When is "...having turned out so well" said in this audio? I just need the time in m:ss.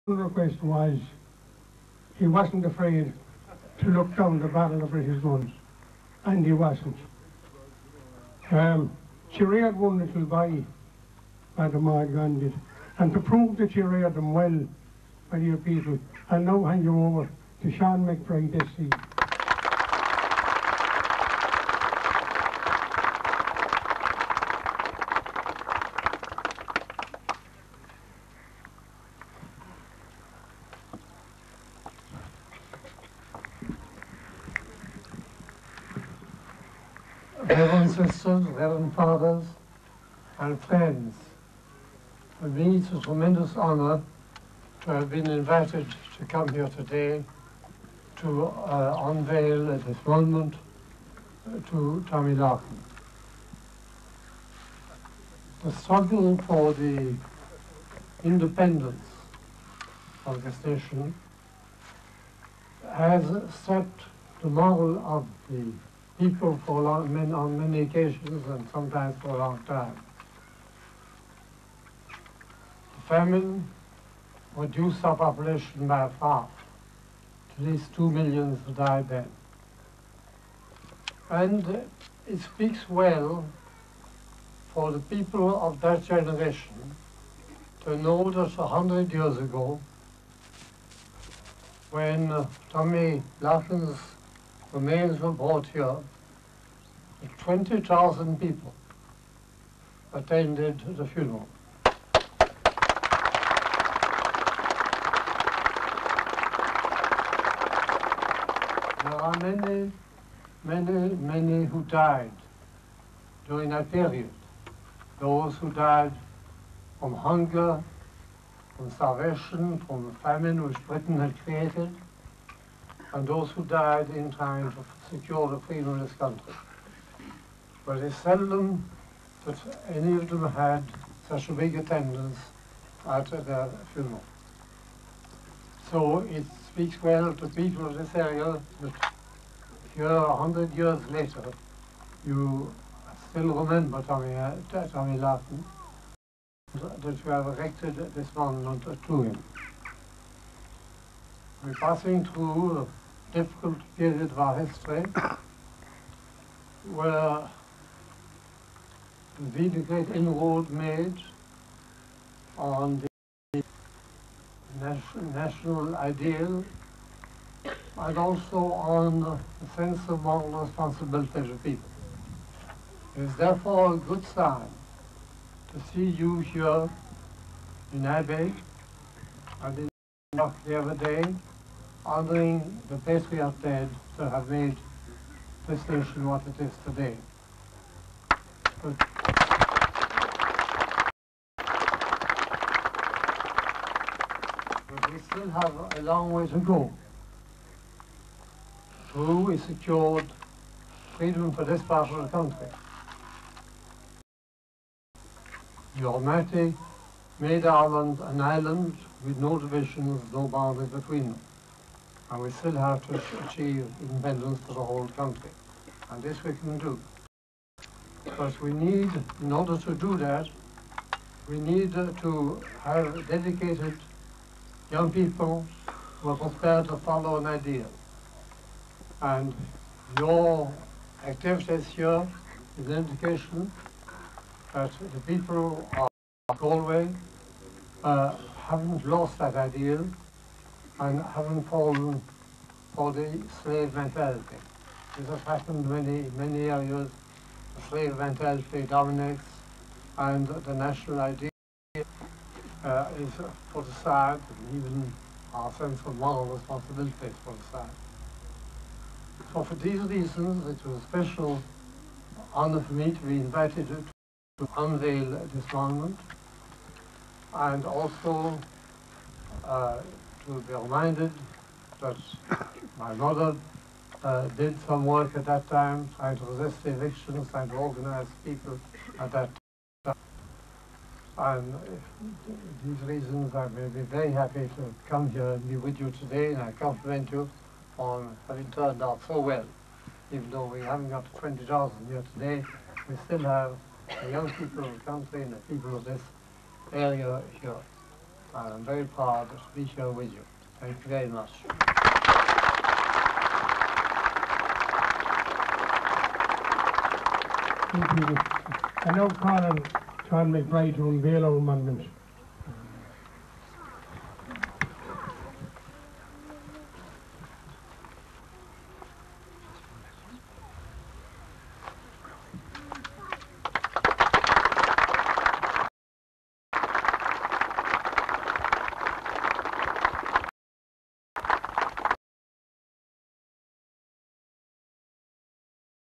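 4:48.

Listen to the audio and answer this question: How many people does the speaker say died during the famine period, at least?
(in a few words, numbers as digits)
2 million.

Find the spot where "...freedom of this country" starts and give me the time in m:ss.
2:05.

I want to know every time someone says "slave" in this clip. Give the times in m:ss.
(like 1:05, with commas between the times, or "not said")
4:03, 4:07.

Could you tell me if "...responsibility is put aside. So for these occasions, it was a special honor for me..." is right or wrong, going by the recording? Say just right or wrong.
wrong.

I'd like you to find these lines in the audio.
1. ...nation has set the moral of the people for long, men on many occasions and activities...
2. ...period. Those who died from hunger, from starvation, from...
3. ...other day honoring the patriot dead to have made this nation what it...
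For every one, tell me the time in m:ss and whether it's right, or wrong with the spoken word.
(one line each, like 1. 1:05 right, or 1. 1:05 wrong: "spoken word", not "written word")
1. 1:00 wrong: "sometimes", not "activities"
2. 1:53 right
3. 3:00 right.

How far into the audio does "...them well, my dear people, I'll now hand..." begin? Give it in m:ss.
0:14.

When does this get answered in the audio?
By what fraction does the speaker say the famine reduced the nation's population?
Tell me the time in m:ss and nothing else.
1:16.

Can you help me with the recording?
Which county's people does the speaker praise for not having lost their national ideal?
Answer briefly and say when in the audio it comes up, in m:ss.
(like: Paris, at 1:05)
Galway, at 3:56.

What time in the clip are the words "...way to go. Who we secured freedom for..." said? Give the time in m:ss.
3:16.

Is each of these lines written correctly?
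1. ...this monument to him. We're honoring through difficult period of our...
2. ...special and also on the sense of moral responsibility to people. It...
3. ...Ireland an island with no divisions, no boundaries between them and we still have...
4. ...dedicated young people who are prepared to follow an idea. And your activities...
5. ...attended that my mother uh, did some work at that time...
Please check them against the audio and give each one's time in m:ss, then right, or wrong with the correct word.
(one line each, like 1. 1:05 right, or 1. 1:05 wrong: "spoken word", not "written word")
1. 2:28 wrong: "passing", not "honoring"
2. 2:45 wrong: "ideal", not "special"
3. 3:27 right
4. 3:43 right
5. 4:30 wrong: "reminded", not "attended".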